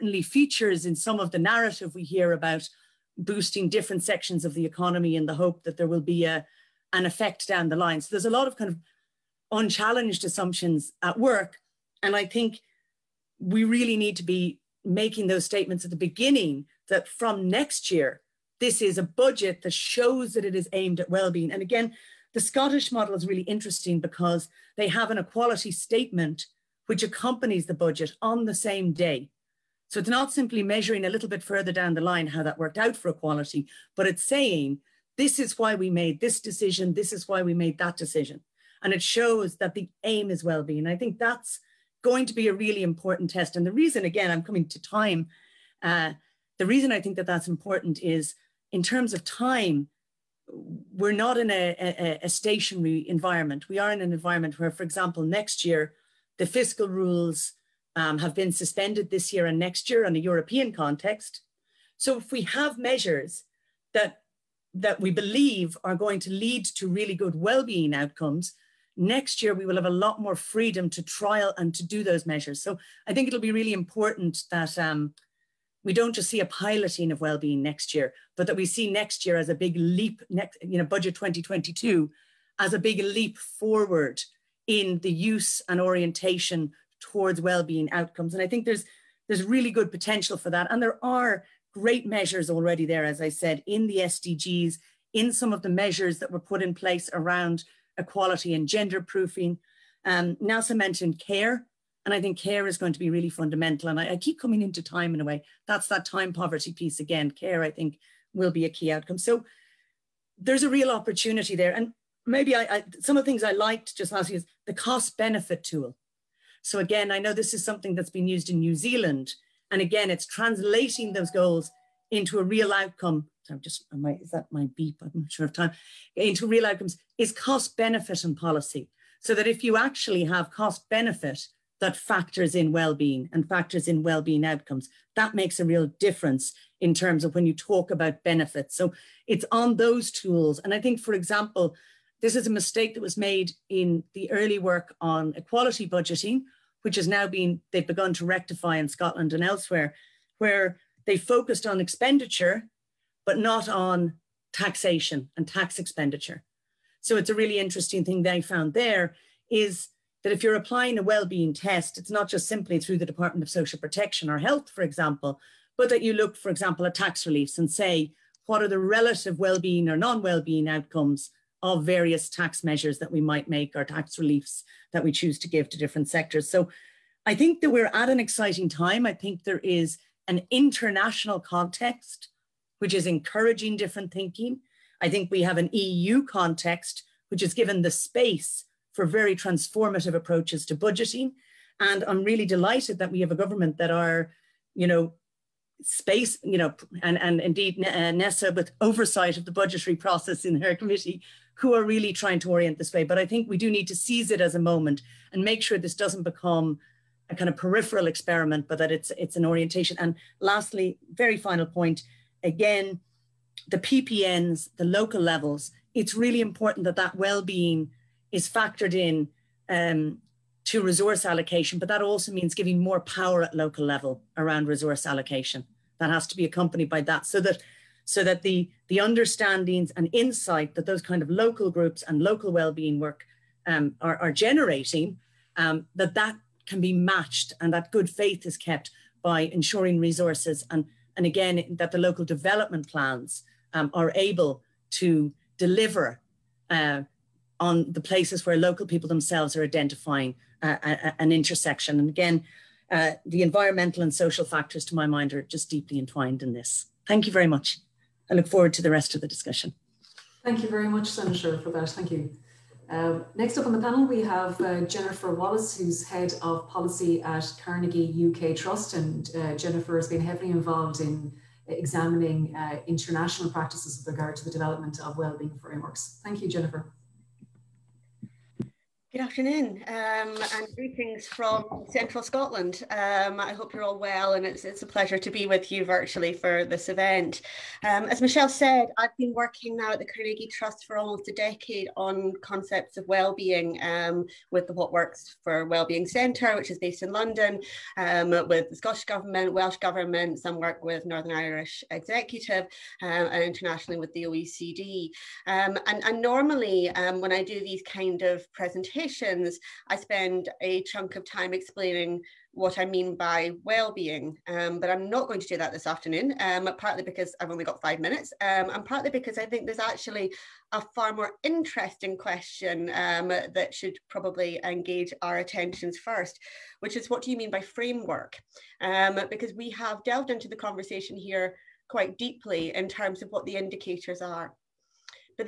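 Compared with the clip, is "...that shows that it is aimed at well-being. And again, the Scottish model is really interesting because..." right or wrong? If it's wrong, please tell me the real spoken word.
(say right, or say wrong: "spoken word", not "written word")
right.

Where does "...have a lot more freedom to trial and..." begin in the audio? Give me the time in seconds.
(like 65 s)
69 s.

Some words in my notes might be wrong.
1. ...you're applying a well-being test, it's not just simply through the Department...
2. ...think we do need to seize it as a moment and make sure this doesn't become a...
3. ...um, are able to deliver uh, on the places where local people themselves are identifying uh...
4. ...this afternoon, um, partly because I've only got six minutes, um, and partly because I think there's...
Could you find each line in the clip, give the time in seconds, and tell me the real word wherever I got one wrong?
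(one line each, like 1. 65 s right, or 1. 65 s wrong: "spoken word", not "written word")
1. 160 s right
2. 203 s right
3. 243 s right
4. 315 s wrong: "five", not "six".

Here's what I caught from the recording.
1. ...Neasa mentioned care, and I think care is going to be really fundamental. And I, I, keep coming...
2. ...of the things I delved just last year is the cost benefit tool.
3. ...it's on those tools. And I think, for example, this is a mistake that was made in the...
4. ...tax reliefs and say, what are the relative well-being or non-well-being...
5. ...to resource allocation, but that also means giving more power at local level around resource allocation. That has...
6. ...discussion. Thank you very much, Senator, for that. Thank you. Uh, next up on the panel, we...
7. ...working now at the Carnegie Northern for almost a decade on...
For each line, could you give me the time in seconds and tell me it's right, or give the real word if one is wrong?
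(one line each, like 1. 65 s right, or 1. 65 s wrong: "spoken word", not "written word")
1. 100 s right
2. 113 s wrong: "liked", not "delved"
3. 139 s right
4. 166 s right
5. 220 s right
6. 259 s right
7. 289 s wrong: "Trust", not "Northern".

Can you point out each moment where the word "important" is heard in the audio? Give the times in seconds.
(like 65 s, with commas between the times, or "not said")
42 s, 47 s, 73 s, 216 s.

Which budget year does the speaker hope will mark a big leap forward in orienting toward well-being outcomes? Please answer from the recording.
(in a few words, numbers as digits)
2022.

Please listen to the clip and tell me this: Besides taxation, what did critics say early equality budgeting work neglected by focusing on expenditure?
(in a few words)
tax expenditure.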